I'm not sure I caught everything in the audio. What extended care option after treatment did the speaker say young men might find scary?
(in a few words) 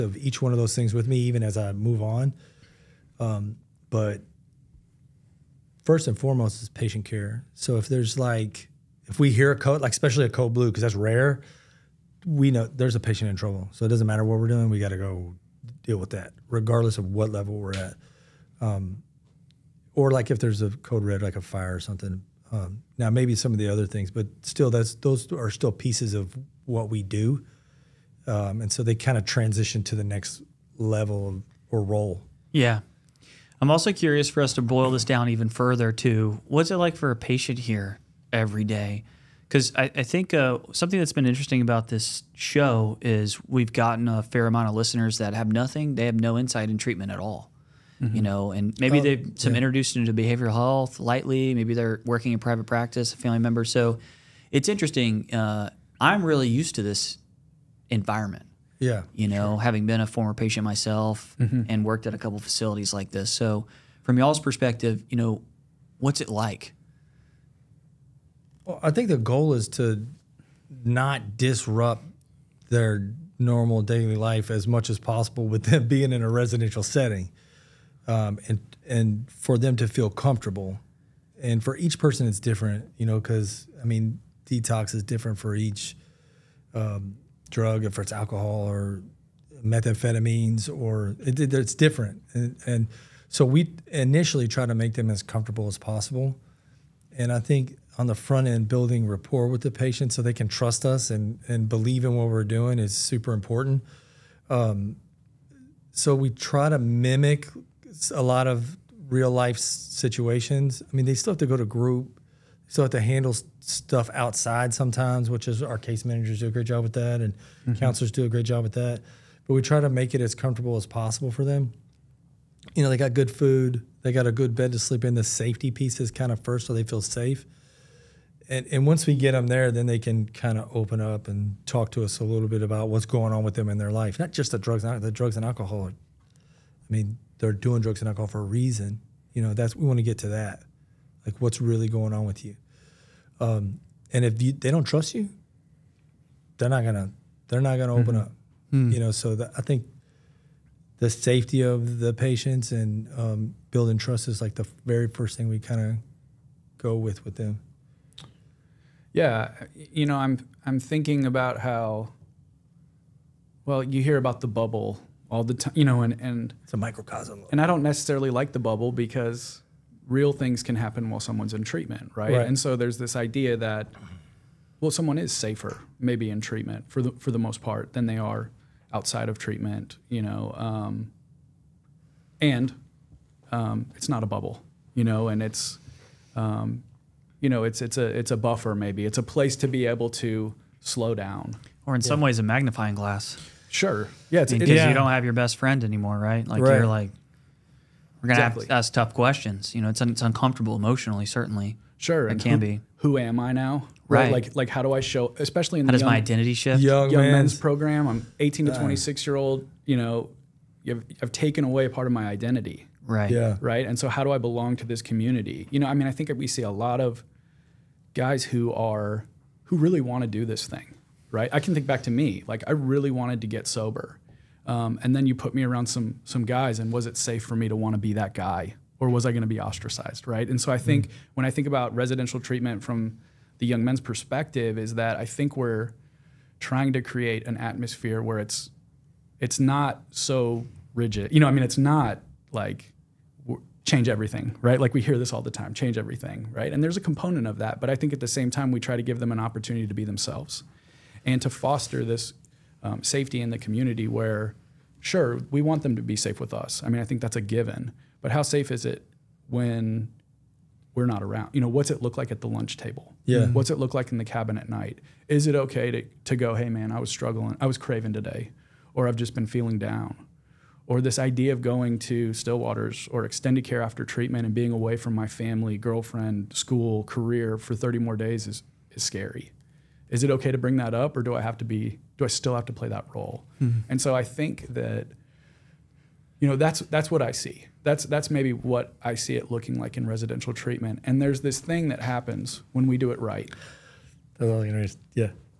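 Stillwaters.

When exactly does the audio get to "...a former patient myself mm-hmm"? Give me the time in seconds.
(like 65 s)
59 s.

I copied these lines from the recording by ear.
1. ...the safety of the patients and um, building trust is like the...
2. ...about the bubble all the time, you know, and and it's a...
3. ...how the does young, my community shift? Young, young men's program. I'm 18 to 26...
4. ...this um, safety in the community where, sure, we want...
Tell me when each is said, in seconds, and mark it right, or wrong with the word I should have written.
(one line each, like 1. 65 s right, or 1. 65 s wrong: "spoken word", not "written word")
1. 150 s right
2. 164 s right
3. 205 s wrong: "identity", not "community"
4. 252 s right.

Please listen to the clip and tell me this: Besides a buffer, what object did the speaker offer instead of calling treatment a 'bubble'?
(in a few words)
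A magnifying glass.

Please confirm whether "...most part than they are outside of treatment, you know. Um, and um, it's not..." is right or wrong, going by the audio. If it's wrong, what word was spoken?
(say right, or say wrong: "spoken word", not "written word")
right.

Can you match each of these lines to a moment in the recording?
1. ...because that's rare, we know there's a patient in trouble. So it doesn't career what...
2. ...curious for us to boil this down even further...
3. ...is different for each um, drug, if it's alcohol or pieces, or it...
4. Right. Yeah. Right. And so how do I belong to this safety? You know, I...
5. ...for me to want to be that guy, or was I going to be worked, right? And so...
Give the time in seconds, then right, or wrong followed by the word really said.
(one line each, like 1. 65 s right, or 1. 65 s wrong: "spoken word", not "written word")
1. 10 s wrong: "matter", not "career"
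2. 33 s right
3. 84 s wrong: "methamphetamines", not "pieces"
4. 213 s wrong: "community", not "safety"
5. 227 s wrong: "ostracized", not "worked".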